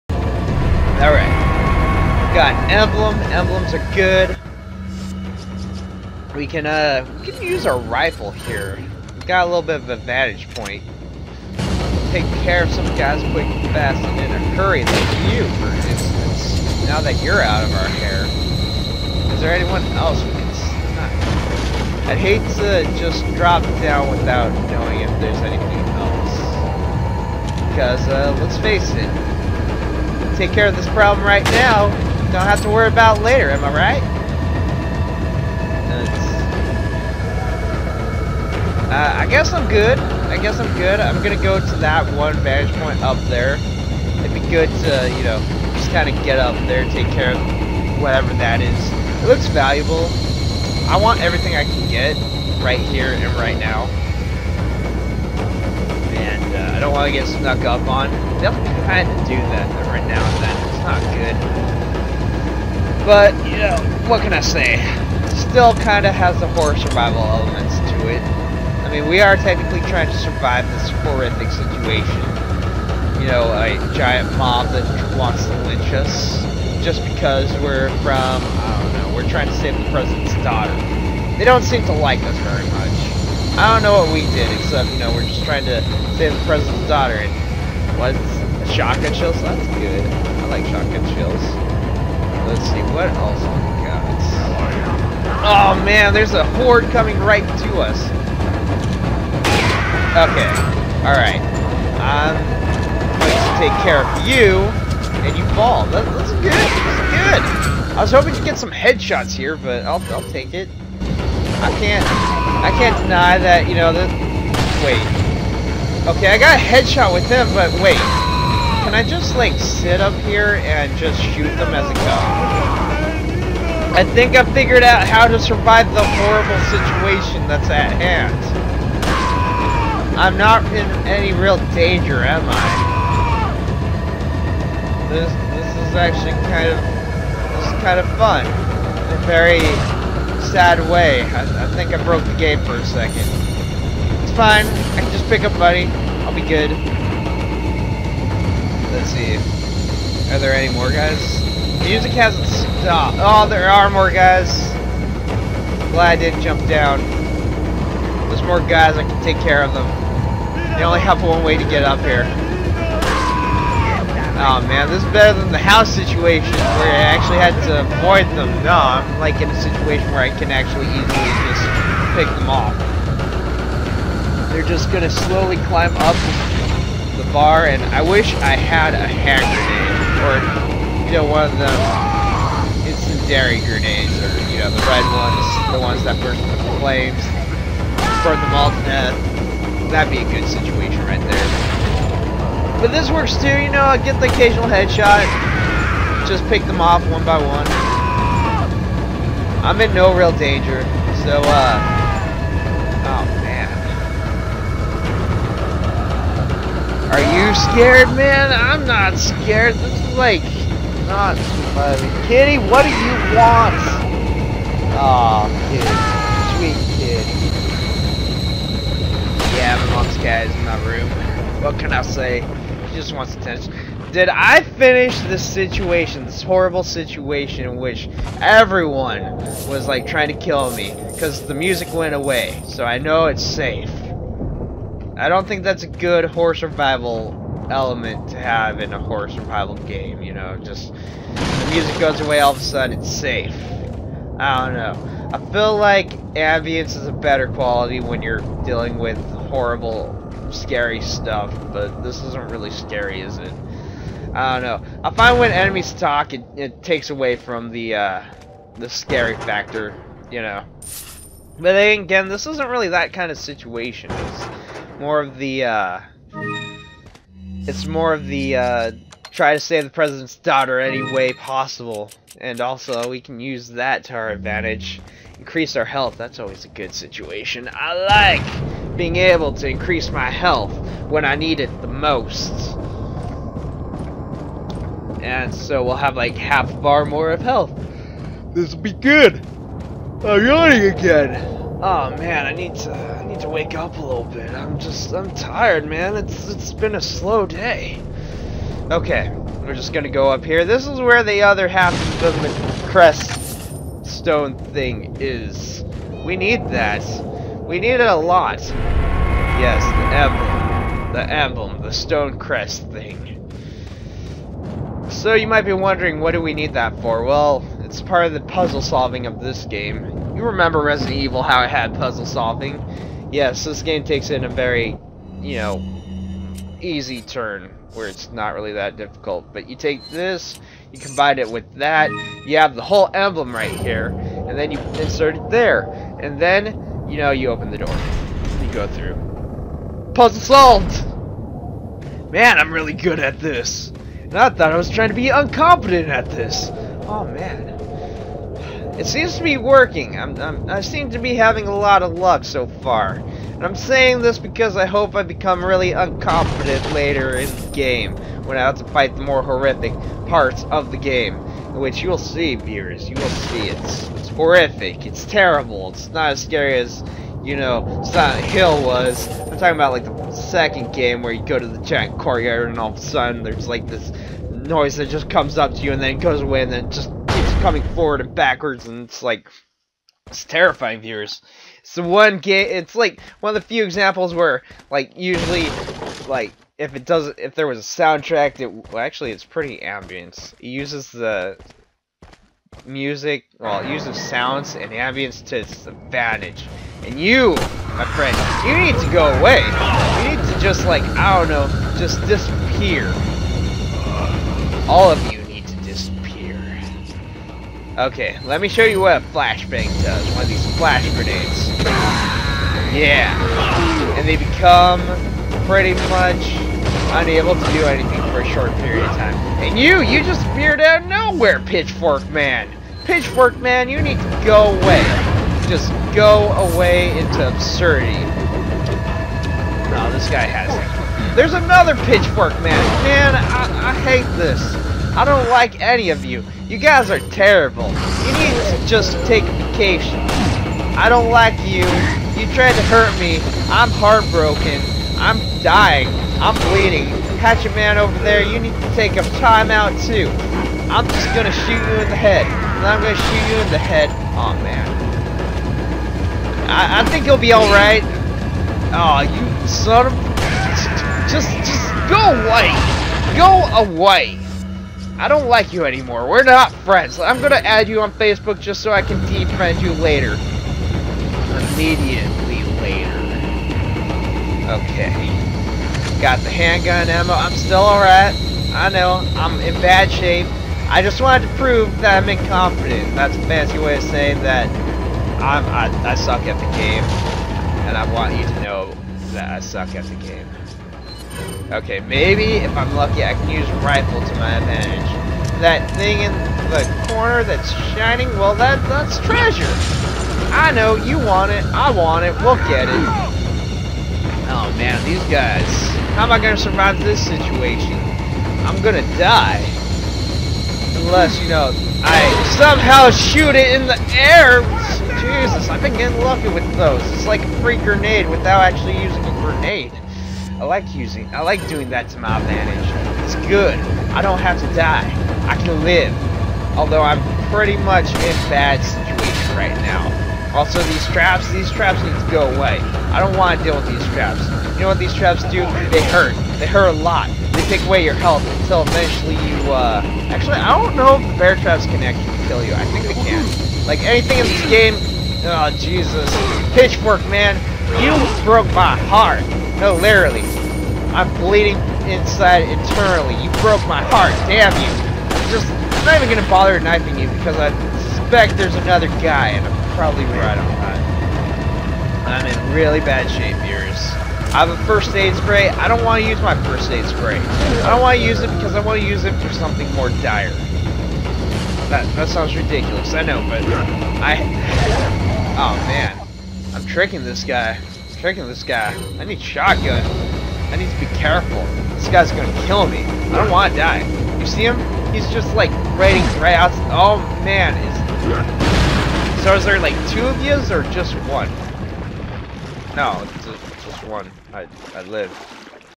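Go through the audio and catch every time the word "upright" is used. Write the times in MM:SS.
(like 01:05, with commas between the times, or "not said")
not said.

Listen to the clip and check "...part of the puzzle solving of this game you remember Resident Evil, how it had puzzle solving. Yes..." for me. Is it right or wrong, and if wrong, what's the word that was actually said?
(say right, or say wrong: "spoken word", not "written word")
right.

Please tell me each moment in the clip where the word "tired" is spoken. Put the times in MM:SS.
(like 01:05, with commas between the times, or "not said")
04:55.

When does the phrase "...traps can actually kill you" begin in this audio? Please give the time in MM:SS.
09:01.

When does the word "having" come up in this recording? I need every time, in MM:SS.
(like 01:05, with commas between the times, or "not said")
05:51.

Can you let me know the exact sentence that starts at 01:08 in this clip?
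I mean, we are technically trying to survive this horrific situation.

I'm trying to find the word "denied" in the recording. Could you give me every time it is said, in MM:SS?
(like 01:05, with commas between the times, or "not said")
not said.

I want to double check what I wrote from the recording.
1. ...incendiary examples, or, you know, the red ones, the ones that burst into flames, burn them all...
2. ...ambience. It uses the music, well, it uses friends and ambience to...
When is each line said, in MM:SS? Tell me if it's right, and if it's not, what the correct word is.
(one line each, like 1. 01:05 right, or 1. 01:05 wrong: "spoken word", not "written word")
1. 03:02 wrong: "grenades", not "examples"
2. 06:29 wrong: "sounds", not "friends".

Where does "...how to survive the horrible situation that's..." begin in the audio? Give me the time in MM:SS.
02:05.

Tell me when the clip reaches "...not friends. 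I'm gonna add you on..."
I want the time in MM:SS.
07:46.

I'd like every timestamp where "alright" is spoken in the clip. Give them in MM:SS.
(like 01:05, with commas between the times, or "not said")
00:01, 01:41, 07:37, 07:57.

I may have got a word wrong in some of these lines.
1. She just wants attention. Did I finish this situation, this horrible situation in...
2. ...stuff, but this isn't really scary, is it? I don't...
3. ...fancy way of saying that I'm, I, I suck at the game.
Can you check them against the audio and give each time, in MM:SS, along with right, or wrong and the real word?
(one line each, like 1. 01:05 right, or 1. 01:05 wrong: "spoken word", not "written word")
1. 03:42 right
2. 04:11 right
3. 08:03 right.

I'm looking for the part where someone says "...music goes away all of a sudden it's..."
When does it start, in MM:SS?
04:01.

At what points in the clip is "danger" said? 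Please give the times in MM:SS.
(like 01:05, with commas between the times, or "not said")
02:11, 03:20.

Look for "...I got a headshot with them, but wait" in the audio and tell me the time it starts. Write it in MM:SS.
01:56.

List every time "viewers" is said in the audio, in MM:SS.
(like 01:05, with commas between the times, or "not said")
06:02, 06:20.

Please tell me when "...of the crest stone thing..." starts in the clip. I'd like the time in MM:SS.
05:02.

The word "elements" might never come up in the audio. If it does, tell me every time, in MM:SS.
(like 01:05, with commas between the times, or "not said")
01:07, 03:57.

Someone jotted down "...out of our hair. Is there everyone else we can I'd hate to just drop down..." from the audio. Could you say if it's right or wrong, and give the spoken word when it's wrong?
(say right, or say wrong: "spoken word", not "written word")
wrong: "anyone", not "everyone".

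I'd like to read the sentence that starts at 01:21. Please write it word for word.
They don't seem to like us very much.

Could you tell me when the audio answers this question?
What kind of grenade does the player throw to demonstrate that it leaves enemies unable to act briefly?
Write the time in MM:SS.
06:49.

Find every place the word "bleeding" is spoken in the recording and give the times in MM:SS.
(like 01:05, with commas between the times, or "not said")
07:26, 09:11.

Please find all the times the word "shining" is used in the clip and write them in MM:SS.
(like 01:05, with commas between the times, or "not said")
08:17.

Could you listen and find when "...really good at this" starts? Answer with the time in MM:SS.
05:42.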